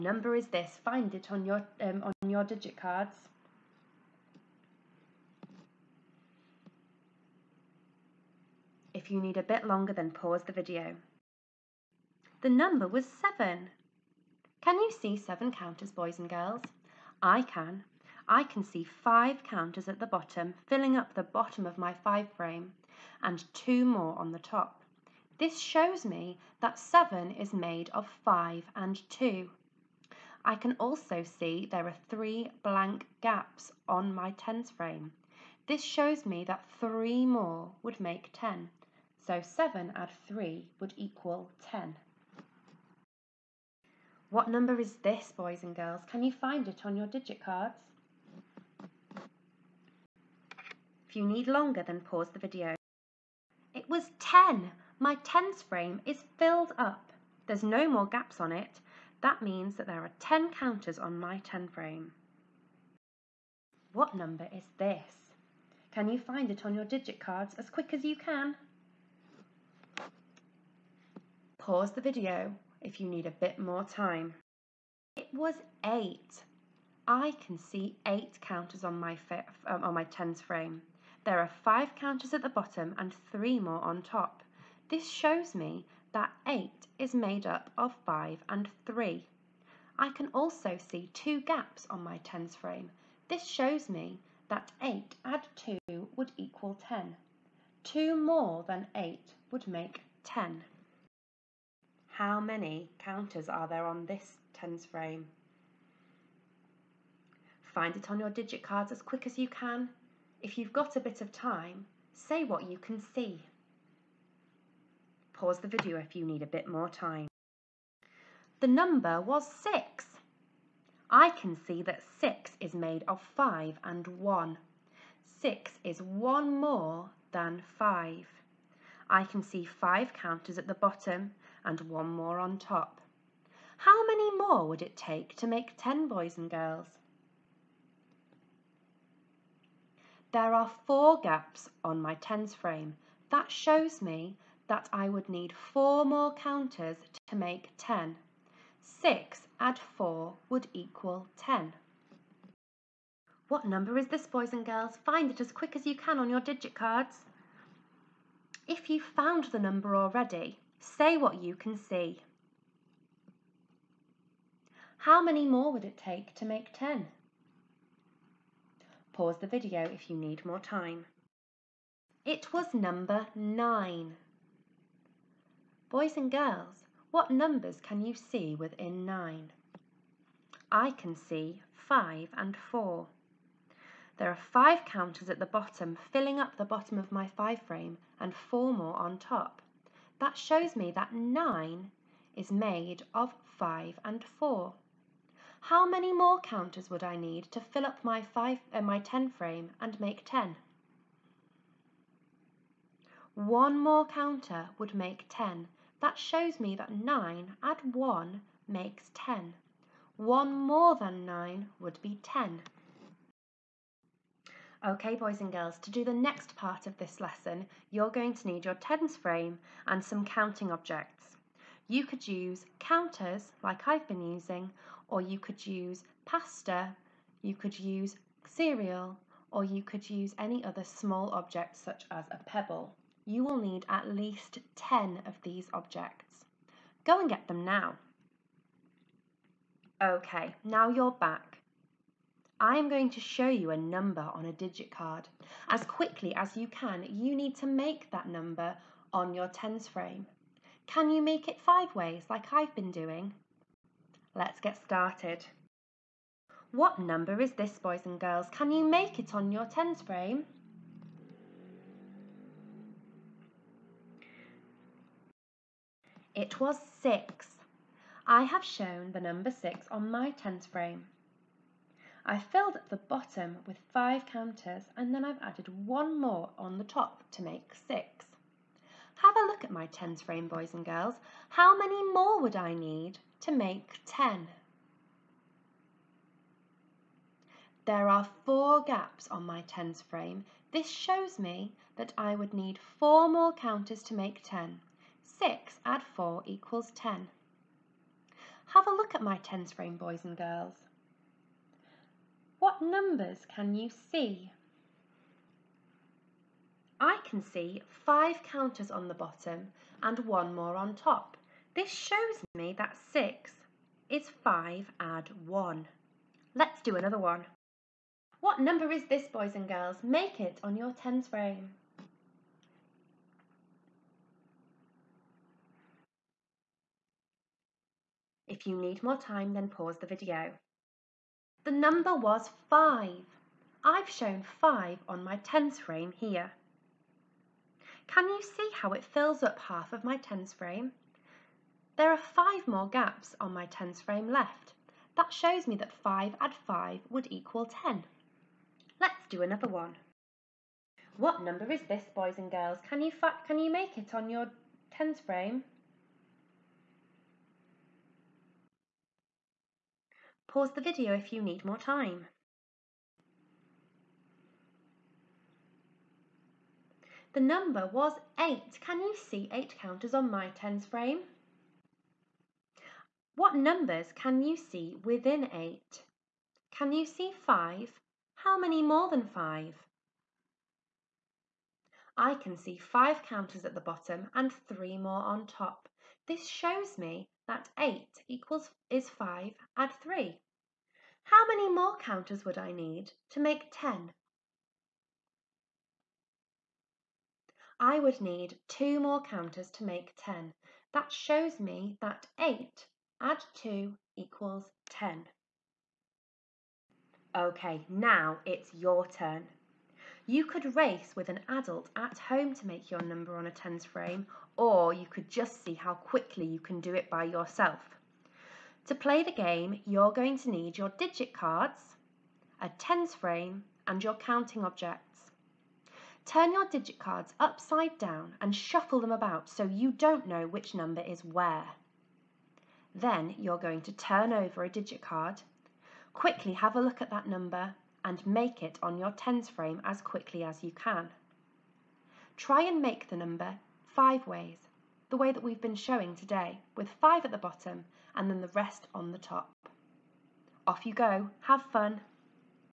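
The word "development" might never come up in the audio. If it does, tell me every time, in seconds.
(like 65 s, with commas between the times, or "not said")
not said.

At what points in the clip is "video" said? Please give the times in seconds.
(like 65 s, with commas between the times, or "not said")
10 s, 52 s, 72 s, 115 s, 169 s, 330 s, 360 s.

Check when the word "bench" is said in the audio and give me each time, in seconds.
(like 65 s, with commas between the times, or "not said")
not said.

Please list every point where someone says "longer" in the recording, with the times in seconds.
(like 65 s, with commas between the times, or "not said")
9 s, 51 s.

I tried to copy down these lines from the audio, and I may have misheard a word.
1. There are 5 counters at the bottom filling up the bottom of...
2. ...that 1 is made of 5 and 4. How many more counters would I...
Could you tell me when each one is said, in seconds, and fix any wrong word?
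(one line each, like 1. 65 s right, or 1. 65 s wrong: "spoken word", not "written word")
1. 184 s right
2. 190 s wrong: "9", not "1".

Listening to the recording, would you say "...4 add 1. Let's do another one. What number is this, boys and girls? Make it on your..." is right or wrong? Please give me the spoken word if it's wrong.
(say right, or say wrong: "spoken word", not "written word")
wrong: "5", not "4".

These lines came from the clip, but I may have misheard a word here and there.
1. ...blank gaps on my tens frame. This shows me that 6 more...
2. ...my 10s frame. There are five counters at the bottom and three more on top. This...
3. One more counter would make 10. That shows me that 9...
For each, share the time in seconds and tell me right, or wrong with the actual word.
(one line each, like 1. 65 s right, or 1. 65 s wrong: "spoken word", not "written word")
1. 32 s wrong: "3", not "6"
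2. 79 s right
3. 203 s right.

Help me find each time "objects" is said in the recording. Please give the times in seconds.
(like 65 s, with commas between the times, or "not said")
220 s, 231 s, 235 s, 424 s.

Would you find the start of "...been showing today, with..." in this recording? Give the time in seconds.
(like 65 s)
445 s.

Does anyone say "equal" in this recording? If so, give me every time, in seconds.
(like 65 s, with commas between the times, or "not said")
40 s, 96 s, 150 s, 296 s, 347 s, 388 s, 404 s.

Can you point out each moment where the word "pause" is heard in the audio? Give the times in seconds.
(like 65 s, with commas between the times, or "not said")
10 s, 51 s, 71 s, 115 s, 169 s, 329 s, 360 s.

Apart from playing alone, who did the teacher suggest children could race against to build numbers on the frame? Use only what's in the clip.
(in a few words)
An adult at home.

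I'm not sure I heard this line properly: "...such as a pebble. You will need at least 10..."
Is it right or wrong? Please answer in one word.
right.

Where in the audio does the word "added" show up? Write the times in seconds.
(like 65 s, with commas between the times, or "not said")
275 s.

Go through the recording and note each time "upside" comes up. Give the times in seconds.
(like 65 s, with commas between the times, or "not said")
427 s.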